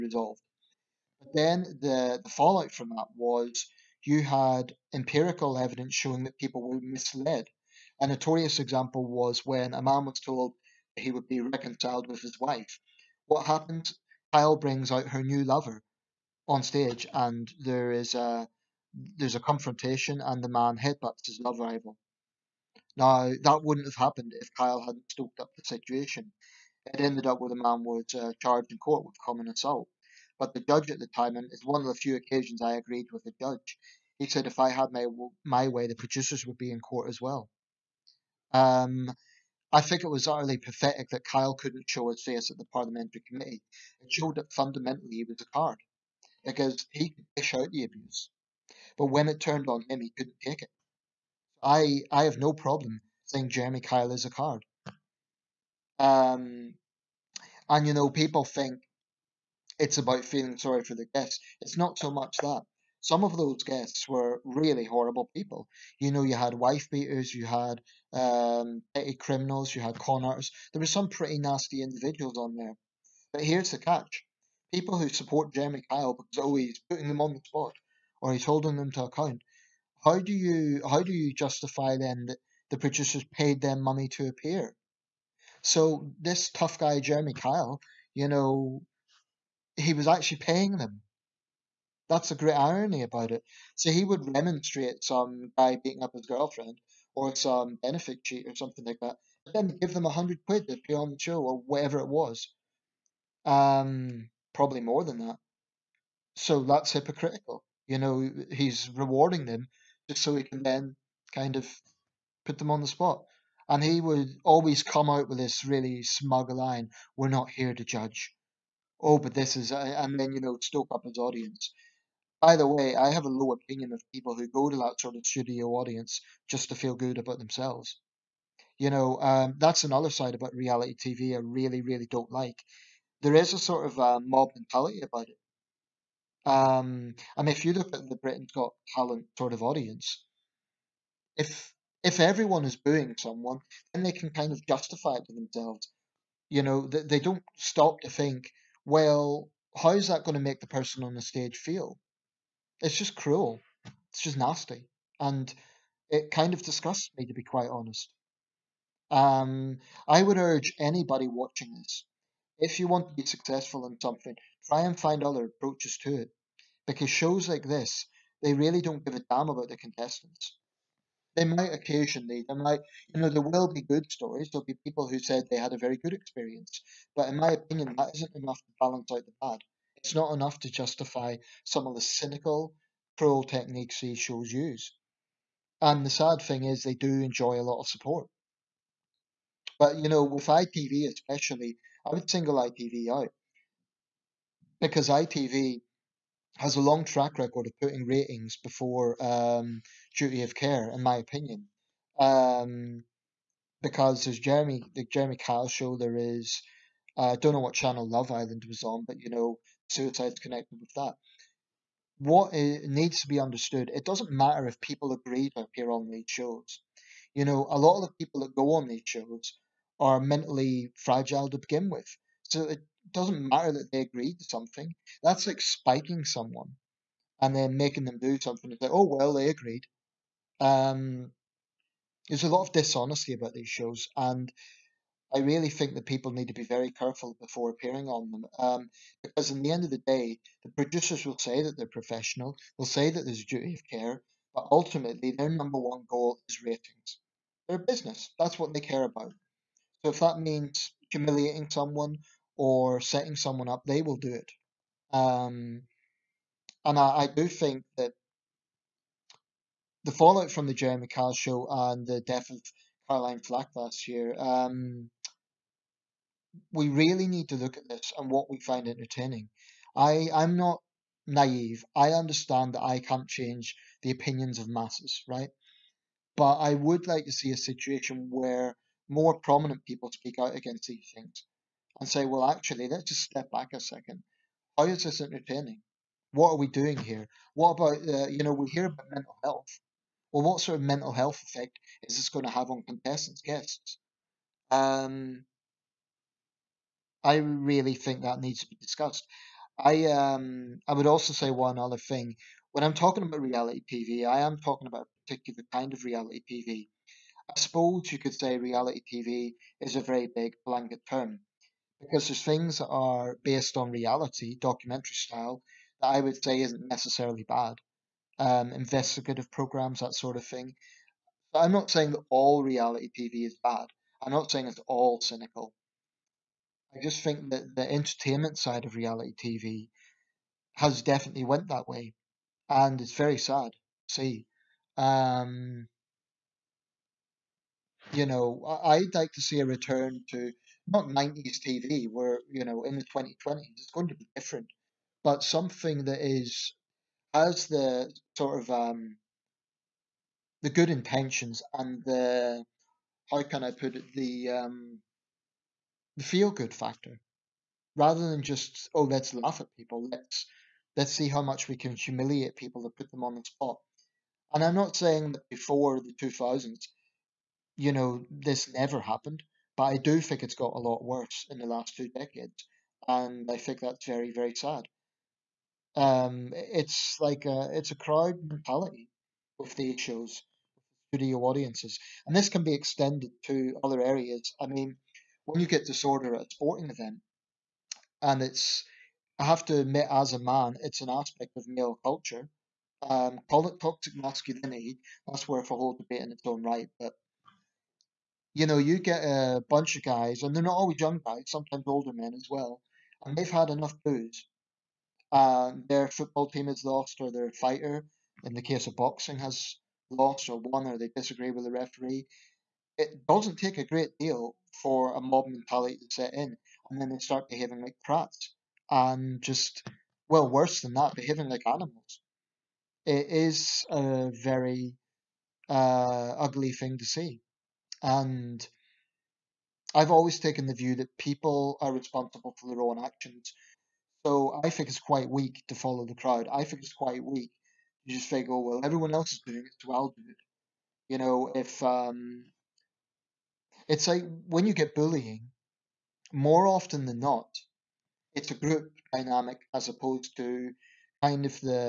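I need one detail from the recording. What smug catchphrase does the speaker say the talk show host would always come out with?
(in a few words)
We're not here to judge.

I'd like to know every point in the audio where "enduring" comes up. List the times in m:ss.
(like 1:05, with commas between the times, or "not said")
not said.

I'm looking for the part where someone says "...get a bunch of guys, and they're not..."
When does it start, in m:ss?
6:38.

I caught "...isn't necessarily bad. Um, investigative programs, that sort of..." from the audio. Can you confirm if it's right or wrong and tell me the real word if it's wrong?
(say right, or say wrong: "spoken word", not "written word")
right.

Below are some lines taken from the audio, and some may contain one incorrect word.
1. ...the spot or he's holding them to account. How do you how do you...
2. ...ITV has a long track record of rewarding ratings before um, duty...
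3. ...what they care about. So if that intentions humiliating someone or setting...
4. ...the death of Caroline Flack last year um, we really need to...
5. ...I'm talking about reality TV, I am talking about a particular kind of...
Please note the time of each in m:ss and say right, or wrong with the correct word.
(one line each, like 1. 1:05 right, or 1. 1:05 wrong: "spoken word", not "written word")
1. 1:17 right
2. 3:15 wrong: "putting", not "rewarding"
3. 4:08 wrong: "means", not "intentions"
4. 4:22 right
5. 5:02 right.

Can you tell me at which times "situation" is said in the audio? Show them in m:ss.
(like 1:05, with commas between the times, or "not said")
0:25, 4:37.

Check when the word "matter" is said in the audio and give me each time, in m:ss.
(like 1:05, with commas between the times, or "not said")
3:34, 3:43.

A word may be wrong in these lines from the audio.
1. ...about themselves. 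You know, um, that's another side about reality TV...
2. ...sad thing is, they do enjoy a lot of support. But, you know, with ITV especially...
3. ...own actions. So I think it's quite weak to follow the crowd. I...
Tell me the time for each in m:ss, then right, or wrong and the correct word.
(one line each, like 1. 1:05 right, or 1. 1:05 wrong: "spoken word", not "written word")
1. 2:07 right
2. 3:06 right
3. 7:12 right.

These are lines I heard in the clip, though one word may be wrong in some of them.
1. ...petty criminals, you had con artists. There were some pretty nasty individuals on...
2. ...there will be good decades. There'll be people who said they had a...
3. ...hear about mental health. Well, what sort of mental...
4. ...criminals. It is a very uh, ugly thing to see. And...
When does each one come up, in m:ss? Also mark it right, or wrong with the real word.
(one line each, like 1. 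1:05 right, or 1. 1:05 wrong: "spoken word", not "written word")
1. 1:08 right
2. 2:53 wrong: "stories", not "decades"
3. 4:48 right
4. 7:01 wrong: "animals", not "criminals".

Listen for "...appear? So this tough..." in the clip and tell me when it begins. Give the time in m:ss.
1:24.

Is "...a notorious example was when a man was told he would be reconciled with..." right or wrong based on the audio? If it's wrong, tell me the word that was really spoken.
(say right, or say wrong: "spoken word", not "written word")
right.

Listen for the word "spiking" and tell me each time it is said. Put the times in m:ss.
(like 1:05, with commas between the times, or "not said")
3:45.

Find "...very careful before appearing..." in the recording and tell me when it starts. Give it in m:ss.
3:56.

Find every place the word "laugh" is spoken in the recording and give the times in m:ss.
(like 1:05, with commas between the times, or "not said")
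5:59.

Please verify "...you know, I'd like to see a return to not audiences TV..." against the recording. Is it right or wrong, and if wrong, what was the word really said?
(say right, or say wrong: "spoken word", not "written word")
wrong: "nineties", not "audiences".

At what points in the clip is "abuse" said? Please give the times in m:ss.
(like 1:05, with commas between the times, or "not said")
0:47.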